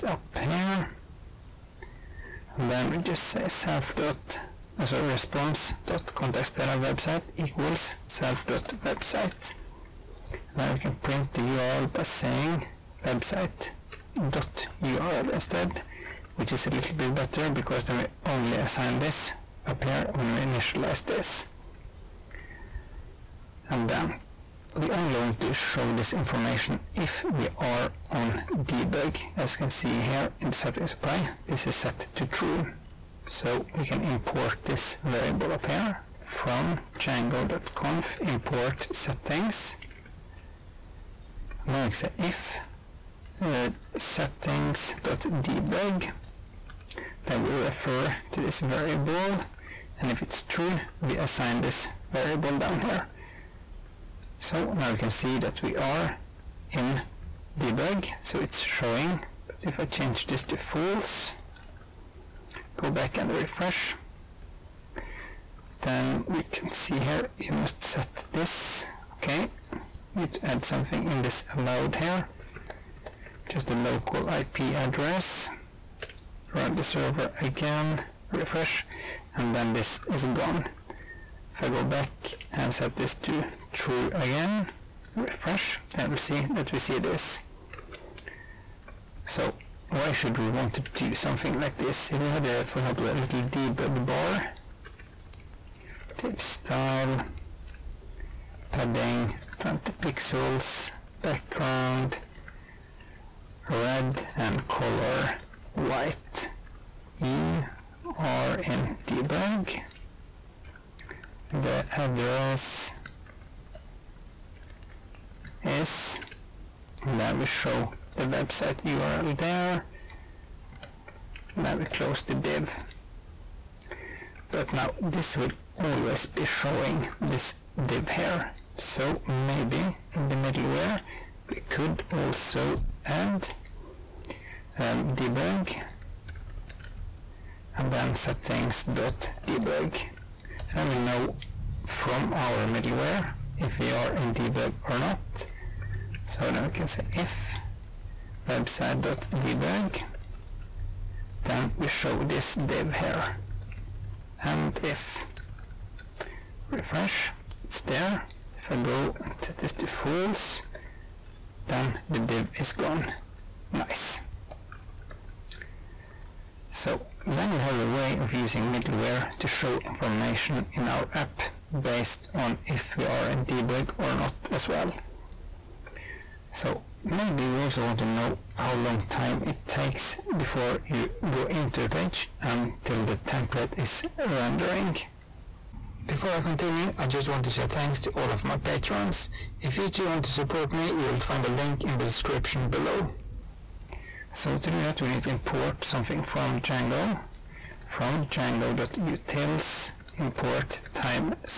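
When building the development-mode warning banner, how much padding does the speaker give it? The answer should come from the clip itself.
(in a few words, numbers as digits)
20 pixels.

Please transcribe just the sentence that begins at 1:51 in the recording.
The address is, and then we show the website URL there.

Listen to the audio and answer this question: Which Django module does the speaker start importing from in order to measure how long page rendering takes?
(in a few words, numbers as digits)
django.utils.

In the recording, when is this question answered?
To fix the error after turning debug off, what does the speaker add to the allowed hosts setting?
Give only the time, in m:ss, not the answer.
1:13.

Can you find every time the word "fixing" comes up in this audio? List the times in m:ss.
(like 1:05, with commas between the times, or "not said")
not said.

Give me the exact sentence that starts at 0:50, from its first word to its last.
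And if it's true, we assign this variable down here.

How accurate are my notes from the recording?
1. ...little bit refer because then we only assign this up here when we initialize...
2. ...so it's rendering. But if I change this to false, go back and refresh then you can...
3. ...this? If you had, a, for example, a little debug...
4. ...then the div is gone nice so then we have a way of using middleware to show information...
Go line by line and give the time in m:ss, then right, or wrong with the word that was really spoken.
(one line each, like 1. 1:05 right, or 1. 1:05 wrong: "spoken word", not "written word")
1. 0:16 wrong: "better", not "refer"
2. 0:58 wrong: "showing", not "rendering"
3. 1:31 right
4. 2:41 right.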